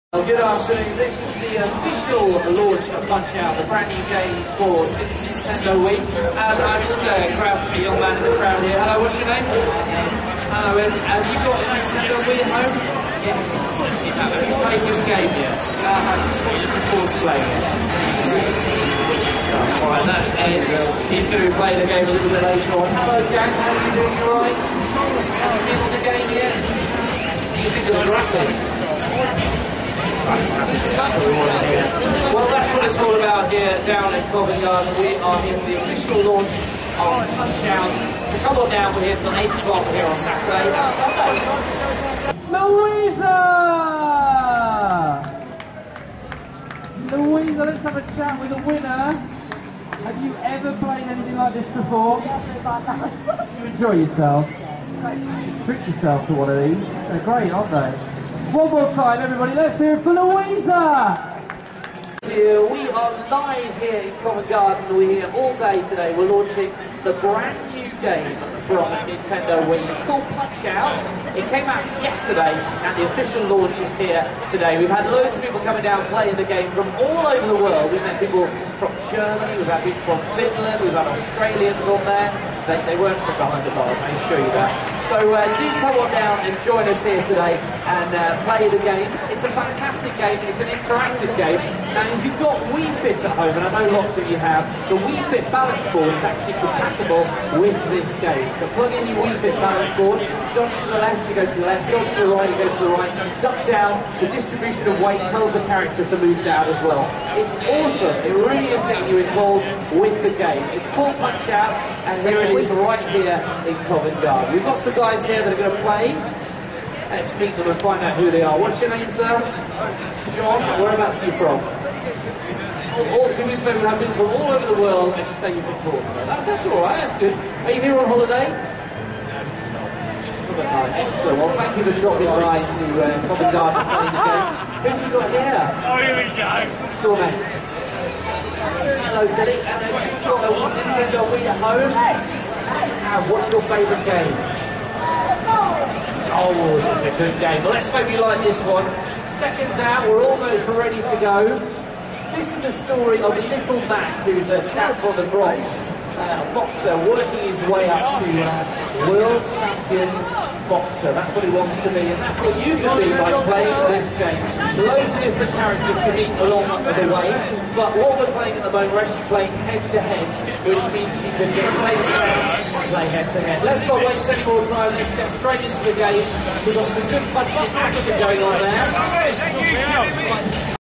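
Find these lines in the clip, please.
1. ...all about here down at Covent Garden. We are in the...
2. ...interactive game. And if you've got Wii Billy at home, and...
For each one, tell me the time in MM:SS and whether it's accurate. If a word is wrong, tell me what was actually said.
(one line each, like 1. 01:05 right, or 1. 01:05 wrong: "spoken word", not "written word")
1. 00:32 right
2. 01:30 wrong: "Fit", not "Billy".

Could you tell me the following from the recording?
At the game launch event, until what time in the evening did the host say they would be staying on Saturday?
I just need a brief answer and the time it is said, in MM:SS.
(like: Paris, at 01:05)
8 o'clock, at 00:39.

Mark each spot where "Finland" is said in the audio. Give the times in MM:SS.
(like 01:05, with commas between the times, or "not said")
01:20.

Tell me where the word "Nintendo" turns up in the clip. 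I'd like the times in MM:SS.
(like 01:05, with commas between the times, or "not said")
00:04, 00:11, 01:09, 02:20.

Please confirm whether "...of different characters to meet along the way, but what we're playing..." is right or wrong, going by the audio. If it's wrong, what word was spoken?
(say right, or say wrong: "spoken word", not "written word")
right.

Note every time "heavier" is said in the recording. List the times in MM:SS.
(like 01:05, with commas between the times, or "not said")
not said.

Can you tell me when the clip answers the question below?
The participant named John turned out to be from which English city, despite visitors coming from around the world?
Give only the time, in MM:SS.
02:05.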